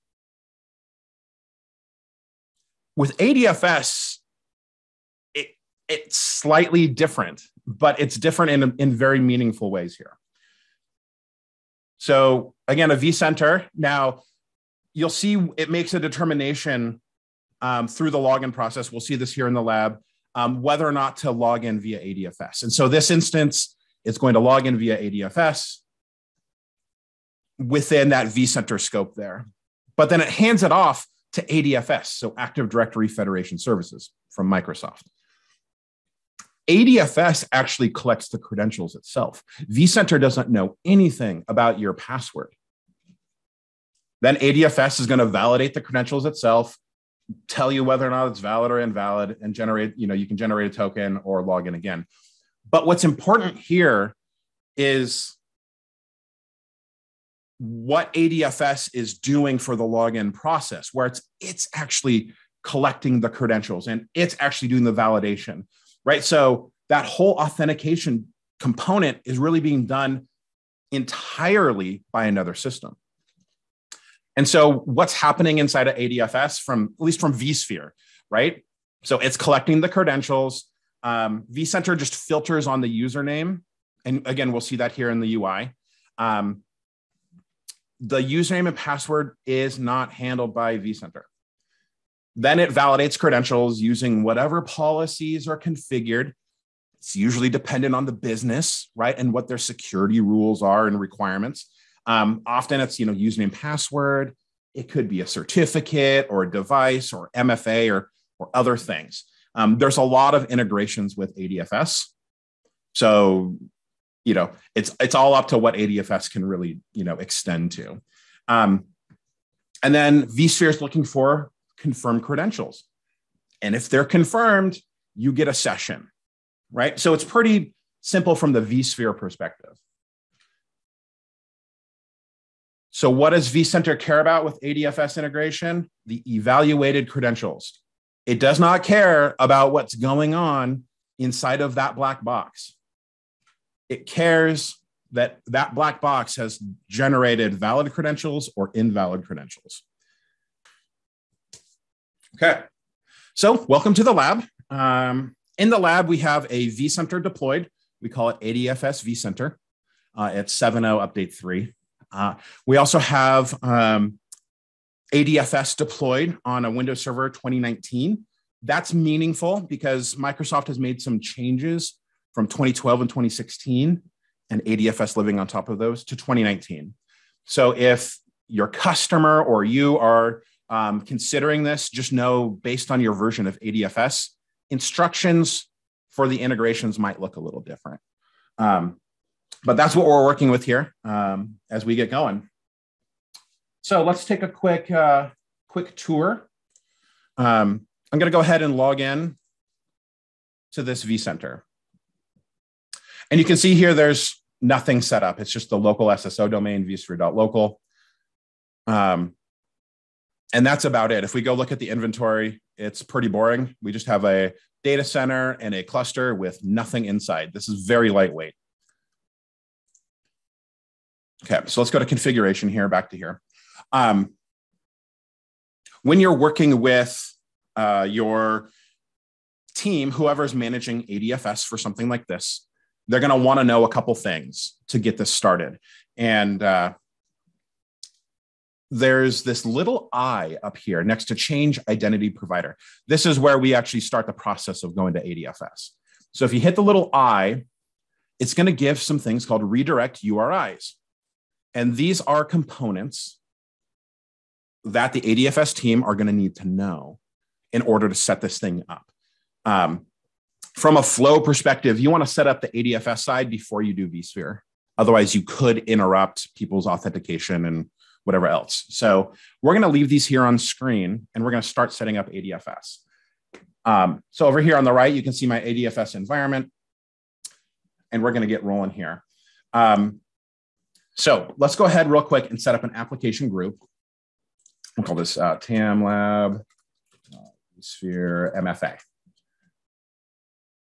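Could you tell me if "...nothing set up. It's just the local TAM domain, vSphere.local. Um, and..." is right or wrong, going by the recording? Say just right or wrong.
wrong.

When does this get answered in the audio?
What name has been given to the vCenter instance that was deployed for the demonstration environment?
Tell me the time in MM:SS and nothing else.
02:38.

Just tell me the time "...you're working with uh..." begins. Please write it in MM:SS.
03:46.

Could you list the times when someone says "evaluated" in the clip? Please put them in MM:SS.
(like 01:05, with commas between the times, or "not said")
02:16.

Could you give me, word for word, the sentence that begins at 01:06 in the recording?
So that whole authentication component is really being done entirely by another system.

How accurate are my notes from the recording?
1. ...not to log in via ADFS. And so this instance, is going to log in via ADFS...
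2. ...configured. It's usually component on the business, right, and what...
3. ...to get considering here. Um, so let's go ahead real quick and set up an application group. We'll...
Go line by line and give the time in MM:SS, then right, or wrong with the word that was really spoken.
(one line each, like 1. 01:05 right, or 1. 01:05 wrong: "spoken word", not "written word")
1. 00:20 right
2. 01:35 wrong: "dependent", not "component"
3. 04:38 wrong: "rolling", not "considering".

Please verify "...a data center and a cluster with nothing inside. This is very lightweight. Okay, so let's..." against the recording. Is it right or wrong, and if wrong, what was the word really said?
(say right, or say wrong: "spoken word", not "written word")
right.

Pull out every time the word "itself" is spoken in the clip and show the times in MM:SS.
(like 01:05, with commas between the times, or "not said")
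00:38, 00:46.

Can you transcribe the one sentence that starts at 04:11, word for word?
And these are components that the ADFS team are going to need to know in order to set this thing up.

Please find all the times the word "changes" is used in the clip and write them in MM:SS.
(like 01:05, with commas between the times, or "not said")
02:51, 04:01.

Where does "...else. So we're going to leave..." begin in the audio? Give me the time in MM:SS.
04:28.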